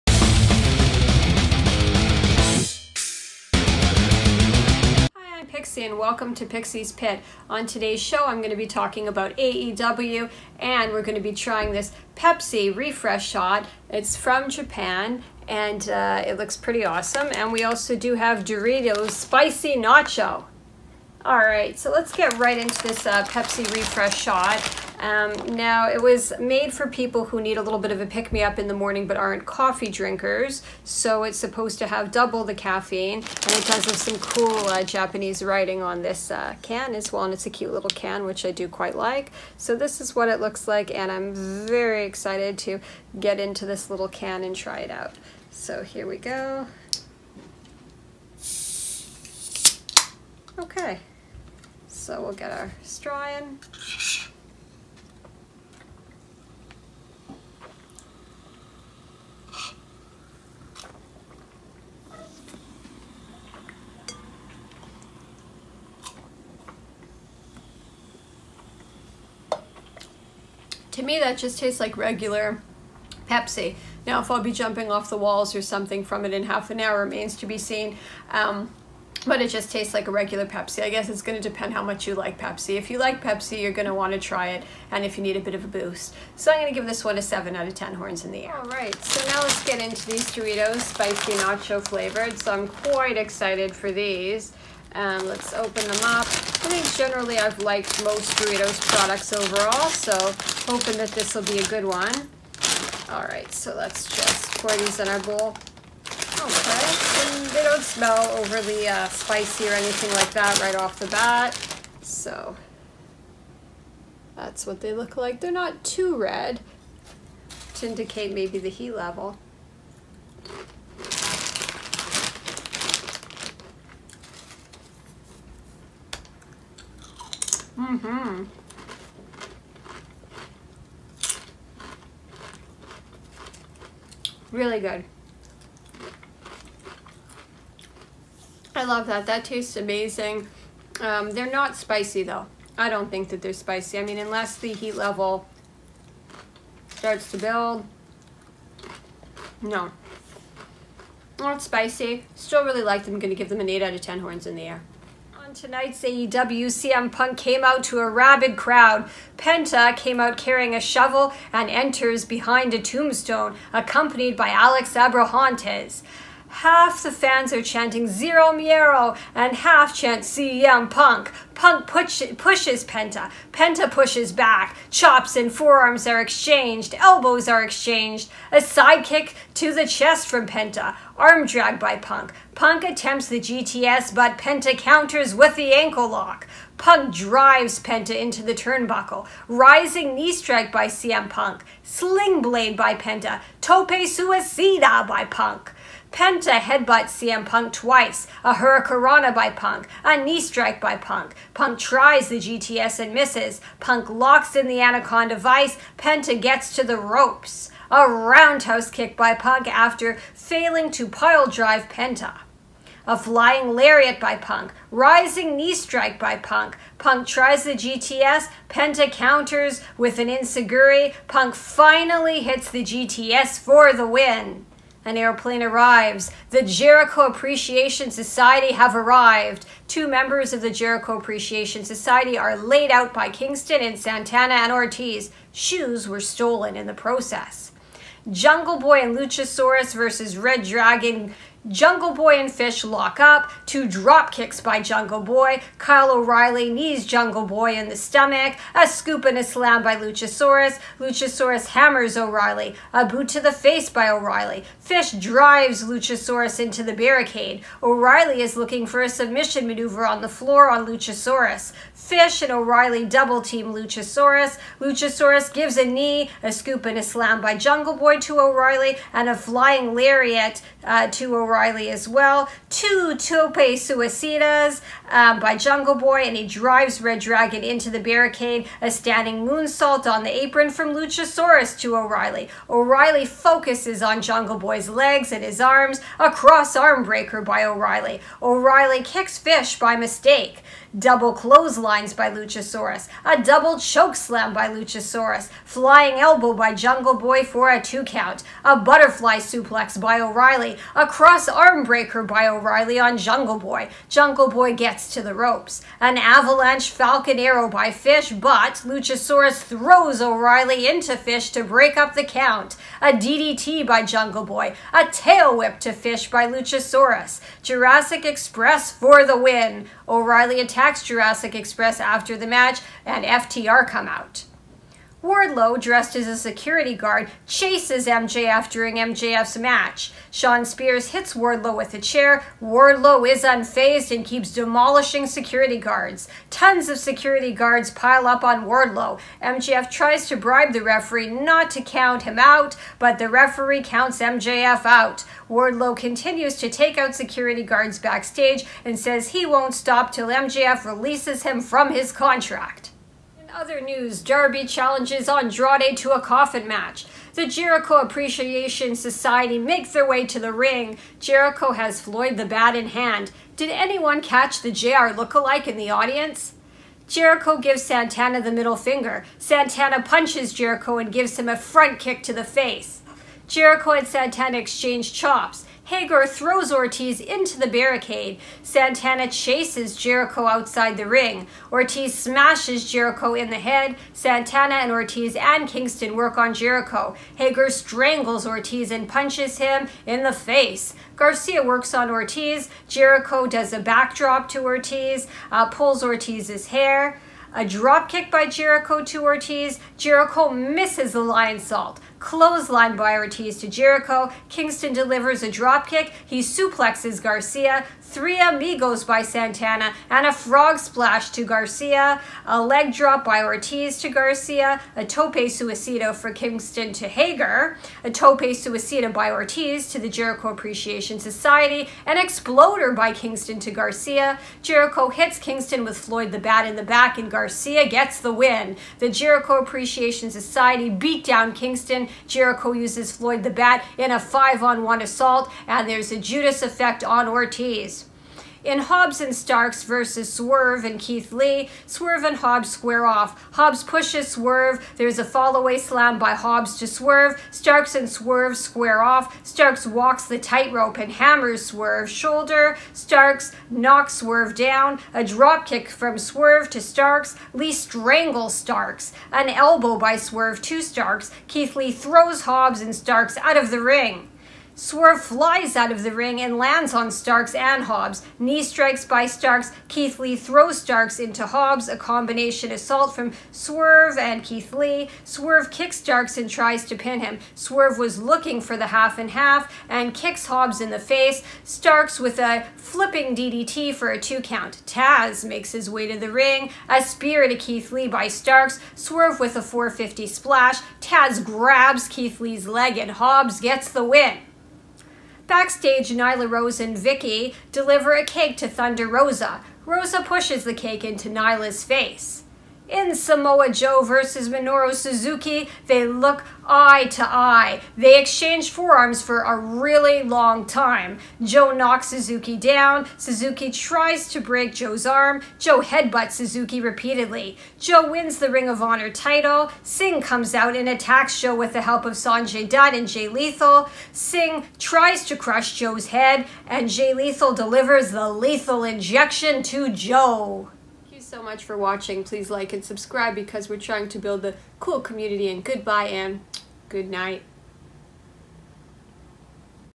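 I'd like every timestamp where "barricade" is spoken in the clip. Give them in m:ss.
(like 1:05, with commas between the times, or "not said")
4:16, 4:37, 6:17.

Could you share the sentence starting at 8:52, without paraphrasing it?
Please like and subscribe because we're trying to build a cool community.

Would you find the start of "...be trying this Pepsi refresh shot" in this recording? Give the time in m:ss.
0:11.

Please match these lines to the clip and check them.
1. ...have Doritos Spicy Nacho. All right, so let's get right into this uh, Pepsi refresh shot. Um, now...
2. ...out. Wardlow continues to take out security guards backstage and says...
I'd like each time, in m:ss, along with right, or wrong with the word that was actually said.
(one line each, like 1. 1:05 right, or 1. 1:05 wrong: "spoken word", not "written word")
1. 0:18 right
2. 5:44 right.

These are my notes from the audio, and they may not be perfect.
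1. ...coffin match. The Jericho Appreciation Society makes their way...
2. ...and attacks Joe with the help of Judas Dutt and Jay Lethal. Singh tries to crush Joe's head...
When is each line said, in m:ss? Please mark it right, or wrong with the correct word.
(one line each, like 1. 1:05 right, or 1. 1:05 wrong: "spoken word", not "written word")
1. 5:56 right
2. 8:40 wrong: "Sanjay", not "Judas".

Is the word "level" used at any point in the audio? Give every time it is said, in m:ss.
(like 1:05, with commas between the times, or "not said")
1:58, 2:24.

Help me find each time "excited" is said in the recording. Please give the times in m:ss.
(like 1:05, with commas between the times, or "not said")
0:42, 1:33.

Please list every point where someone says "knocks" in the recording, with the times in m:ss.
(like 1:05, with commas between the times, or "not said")
7:33, 8:31.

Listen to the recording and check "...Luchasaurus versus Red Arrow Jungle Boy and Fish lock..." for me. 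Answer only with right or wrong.
wrong.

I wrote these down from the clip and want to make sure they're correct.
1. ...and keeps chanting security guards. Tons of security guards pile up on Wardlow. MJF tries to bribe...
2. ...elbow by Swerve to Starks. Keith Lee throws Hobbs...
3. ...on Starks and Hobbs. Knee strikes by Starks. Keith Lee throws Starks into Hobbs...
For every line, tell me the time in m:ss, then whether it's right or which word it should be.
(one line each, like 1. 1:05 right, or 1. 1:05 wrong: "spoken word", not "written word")
1. 5:34 wrong: "demolishing", not "chanting"
2. 7:39 right
3. 7:46 right.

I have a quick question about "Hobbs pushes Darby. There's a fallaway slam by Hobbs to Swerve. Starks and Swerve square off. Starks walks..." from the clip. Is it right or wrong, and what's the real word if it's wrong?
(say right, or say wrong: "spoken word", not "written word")
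wrong: "Swerve", not "Darby".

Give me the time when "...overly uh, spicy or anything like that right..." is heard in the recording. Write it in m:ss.
1:48.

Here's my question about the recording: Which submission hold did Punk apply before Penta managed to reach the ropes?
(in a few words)
Anaconda Vice.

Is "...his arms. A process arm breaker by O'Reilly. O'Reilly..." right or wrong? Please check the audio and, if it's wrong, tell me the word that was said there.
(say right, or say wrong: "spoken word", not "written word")
wrong: "cross", not "process".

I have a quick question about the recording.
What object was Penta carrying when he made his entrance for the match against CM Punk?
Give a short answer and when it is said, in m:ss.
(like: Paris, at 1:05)
A shovel, at 2:40.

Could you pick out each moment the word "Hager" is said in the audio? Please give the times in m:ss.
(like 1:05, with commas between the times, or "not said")
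6:15, 6:27, 6:57.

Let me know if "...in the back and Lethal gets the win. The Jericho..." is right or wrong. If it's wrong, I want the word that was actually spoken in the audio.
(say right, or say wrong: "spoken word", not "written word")
wrong: "Garcia", not "Lethal".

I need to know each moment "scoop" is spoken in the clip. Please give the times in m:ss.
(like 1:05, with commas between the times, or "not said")
4:08, 4:26.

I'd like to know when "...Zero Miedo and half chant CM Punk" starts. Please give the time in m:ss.
2:48.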